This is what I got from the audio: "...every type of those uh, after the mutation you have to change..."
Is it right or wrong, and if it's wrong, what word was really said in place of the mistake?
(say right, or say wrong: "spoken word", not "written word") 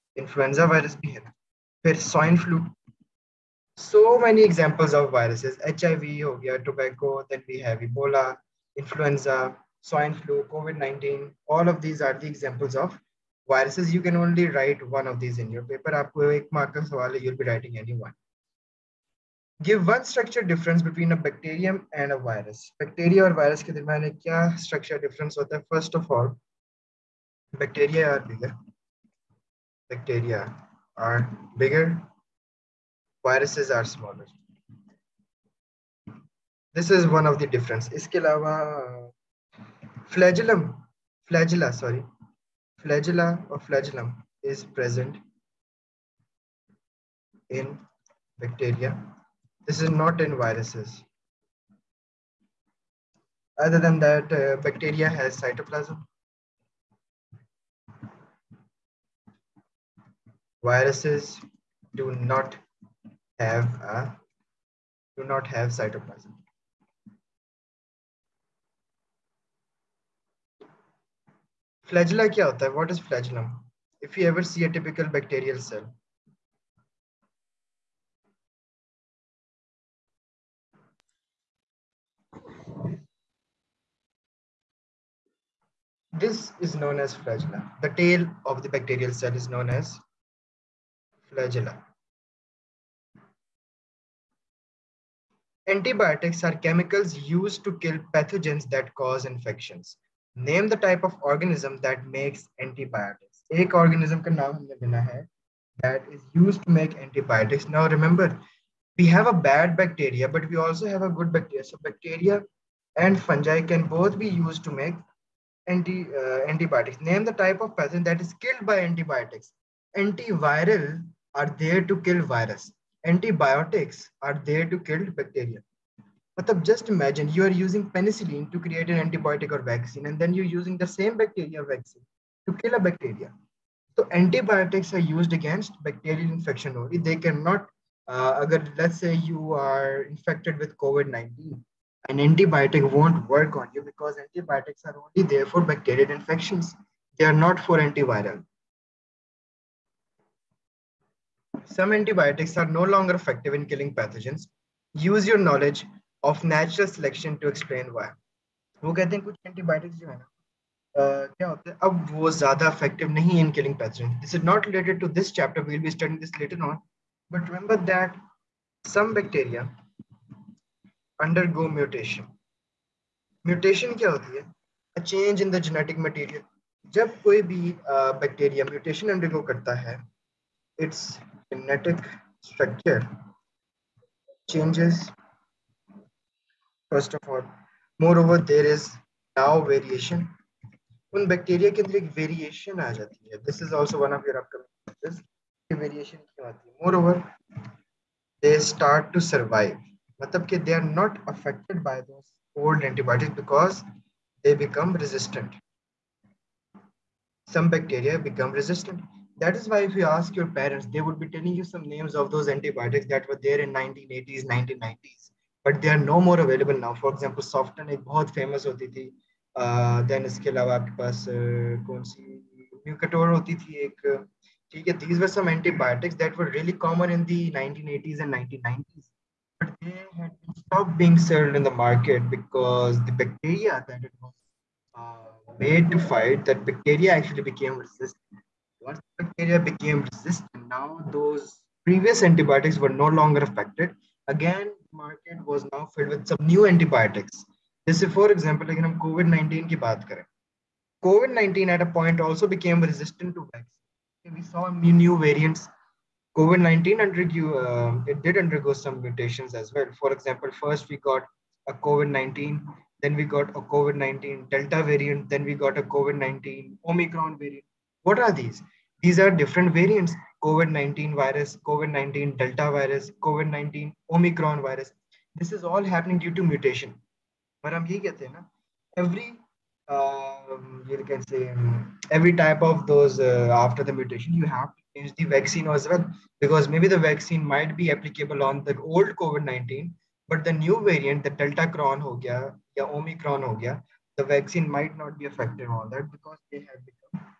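right.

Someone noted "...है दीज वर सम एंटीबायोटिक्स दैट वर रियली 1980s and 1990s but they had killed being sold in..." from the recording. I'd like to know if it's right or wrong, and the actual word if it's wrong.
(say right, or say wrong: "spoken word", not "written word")
wrong: "stopped", not "killed".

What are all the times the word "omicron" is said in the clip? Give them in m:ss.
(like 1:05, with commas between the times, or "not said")
4:26, 4:34, 4:52.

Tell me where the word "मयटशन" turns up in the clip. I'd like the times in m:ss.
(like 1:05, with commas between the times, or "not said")
2:53, 2:58.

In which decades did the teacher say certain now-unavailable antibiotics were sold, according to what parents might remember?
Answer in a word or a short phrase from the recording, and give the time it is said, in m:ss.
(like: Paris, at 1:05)
1980s and 1990s, at 3:33.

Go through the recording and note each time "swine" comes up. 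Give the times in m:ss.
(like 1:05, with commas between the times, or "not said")
0:01, 0:09.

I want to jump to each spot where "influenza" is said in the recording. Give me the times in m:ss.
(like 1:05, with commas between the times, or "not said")
0:00, 0:08.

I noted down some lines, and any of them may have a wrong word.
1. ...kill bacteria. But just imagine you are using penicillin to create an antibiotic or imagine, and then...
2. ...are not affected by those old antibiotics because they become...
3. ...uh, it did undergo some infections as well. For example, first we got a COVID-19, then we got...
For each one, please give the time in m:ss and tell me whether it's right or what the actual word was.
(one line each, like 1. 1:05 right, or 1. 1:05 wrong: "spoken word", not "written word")
1. 2:04 wrong: "vaccine", not "imagine"
2. 3:20 right
3. 4:17 wrong: "mutations", not "infections".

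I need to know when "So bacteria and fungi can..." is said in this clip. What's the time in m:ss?
1:51.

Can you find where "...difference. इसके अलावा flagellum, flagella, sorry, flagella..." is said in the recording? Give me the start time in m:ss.
0:37.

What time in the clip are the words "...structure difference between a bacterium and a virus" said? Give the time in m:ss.
0:20.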